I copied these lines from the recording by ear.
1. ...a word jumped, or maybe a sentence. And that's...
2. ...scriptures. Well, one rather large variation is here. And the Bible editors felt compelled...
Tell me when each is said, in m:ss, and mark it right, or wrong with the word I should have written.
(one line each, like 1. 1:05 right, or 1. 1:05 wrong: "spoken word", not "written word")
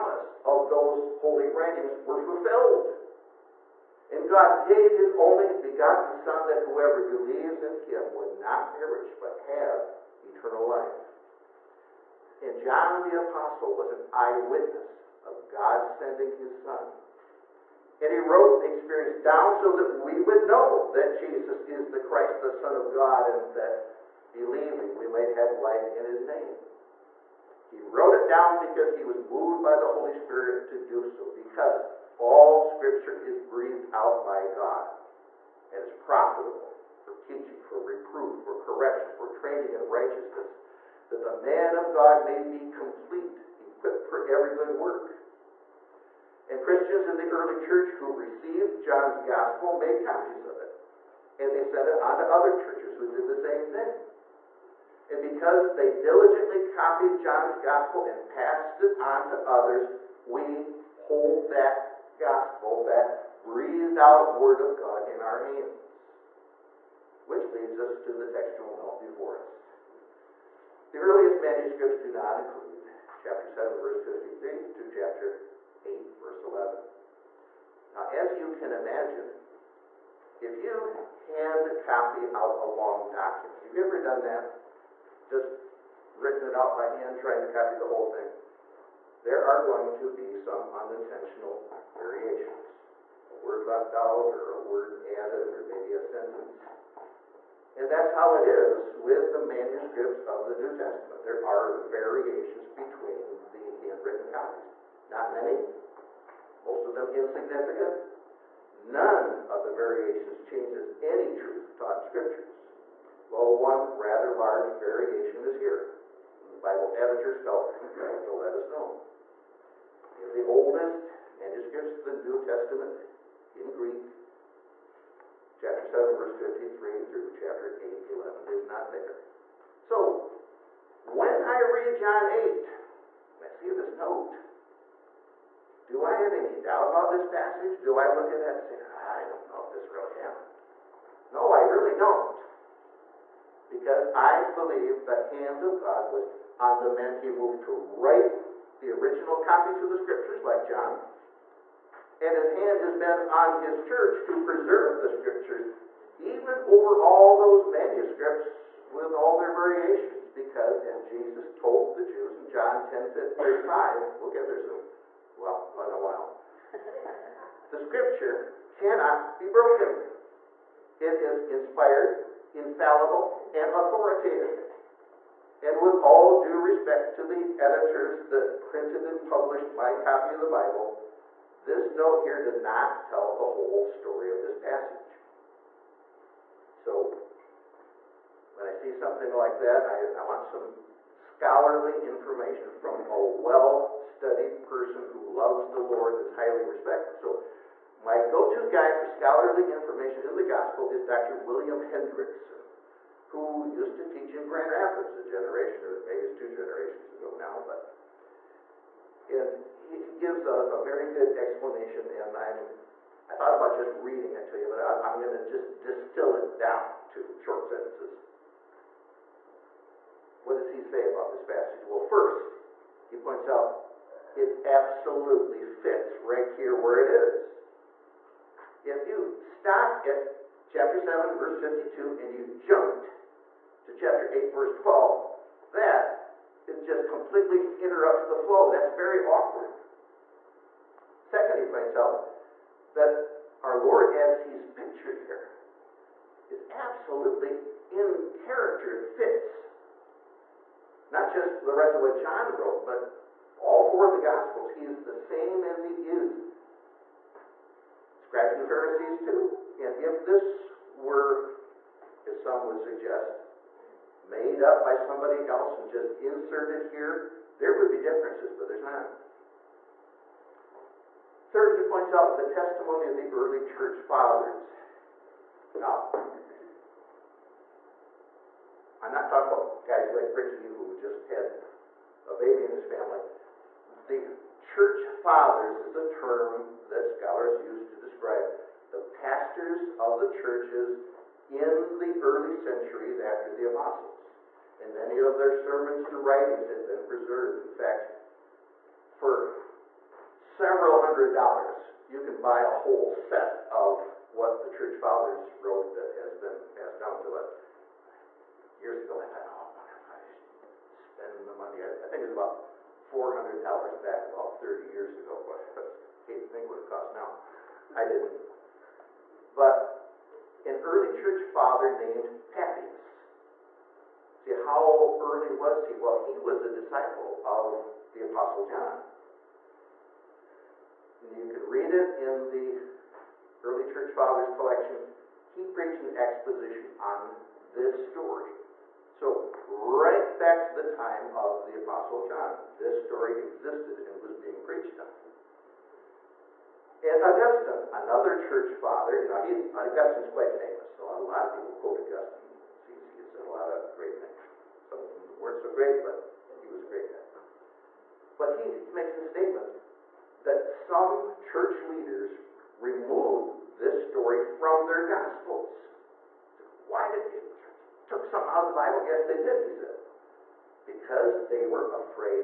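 1. 1:34 wrong: "added", not "jumped"
2. 1:52 right.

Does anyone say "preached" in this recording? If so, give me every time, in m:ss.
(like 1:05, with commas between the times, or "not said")
5:35, 5:44.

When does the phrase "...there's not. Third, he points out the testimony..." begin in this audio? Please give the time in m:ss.
4:28.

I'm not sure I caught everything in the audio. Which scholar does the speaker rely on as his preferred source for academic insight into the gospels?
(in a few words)
William Hendriksen.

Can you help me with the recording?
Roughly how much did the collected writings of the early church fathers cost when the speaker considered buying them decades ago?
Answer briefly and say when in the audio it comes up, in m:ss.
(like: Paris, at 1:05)
$400, at 5:13.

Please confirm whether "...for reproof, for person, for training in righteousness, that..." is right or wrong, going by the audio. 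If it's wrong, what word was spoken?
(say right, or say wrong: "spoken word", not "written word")
wrong: "correction", not "person".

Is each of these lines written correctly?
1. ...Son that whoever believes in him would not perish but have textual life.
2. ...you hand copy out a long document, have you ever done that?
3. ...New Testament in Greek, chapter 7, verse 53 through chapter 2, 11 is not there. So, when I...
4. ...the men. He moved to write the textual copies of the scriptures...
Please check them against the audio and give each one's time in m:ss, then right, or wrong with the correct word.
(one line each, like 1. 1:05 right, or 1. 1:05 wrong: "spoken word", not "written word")
1. 0:06 wrong: "eternal", not "textual"
2. 1:20 right
3. 2:02 wrong: "8", not "2"
4. 2:26 wrong: "original", not "textual".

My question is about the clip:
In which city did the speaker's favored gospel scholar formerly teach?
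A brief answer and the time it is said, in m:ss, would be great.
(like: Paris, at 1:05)
Grand Rapids, at 3:24.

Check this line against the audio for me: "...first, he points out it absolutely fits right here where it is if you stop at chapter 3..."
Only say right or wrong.
wrong.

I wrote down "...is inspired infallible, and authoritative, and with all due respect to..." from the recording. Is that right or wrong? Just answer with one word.
right.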